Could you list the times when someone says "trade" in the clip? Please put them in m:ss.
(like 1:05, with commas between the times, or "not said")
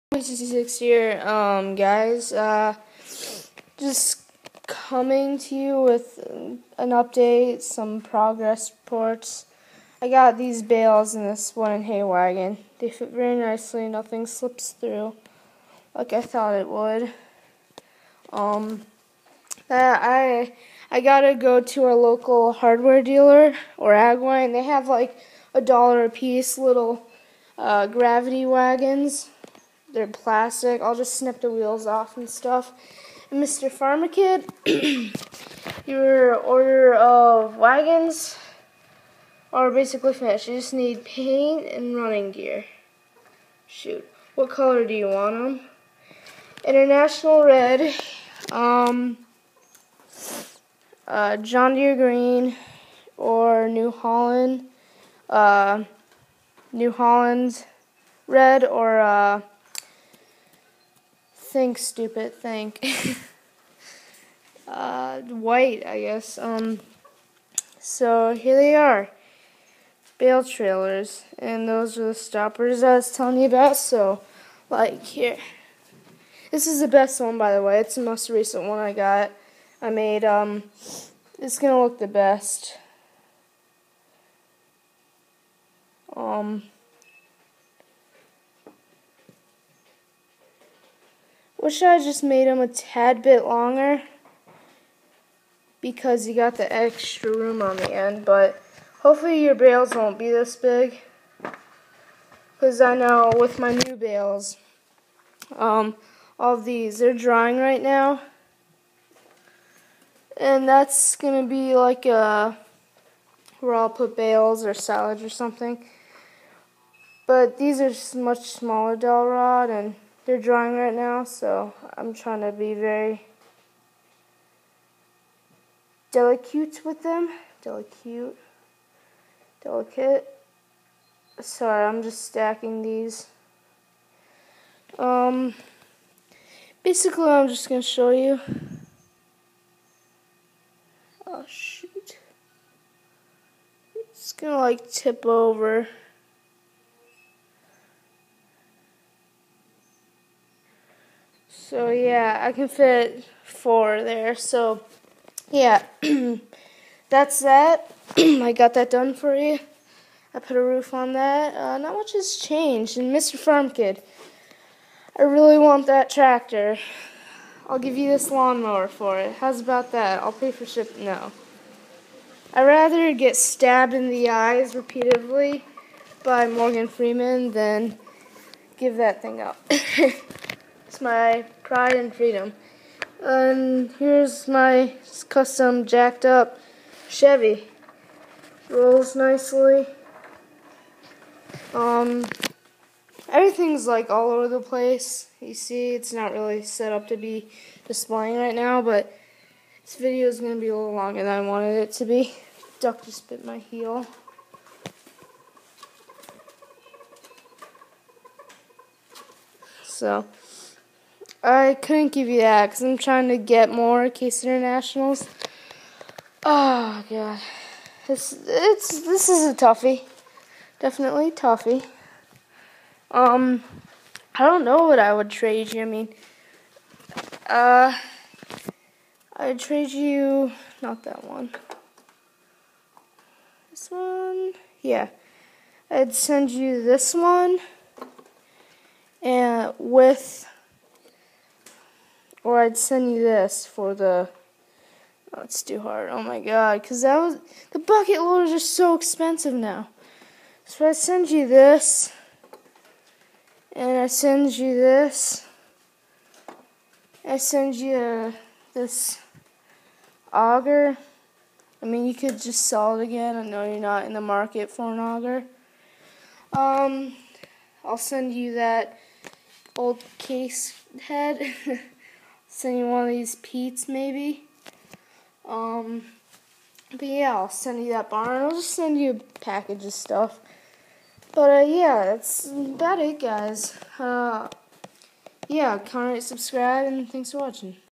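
3:45, 3:49.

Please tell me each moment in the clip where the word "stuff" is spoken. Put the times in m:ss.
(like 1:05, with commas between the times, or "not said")
0:32, 4:39.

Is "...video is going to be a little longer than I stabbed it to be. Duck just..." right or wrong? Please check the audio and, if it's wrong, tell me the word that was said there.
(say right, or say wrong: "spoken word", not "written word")
wrong: "wanted", not "stabbed".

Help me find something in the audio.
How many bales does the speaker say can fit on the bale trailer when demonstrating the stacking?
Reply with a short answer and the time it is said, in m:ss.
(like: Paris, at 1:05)
4, at 2:33.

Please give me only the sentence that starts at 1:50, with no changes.
And that's going to be like a, where I'll put bales or salads or something.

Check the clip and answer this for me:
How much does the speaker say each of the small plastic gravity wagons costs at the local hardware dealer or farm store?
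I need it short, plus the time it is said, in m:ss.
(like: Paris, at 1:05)
a dollar, at 0:25.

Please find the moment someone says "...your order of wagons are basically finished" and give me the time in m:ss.
0:35.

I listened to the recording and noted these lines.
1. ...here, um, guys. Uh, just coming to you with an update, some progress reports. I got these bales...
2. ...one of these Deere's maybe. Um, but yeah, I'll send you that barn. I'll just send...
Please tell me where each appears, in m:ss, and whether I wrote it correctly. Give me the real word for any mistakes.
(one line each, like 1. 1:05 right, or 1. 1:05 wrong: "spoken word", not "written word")
1. 0:00 right
2. 4:32 wrong: "Pete", not "Deere".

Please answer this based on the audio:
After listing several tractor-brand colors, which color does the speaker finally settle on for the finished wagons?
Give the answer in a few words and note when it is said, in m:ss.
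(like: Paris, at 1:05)
white, at 1:05.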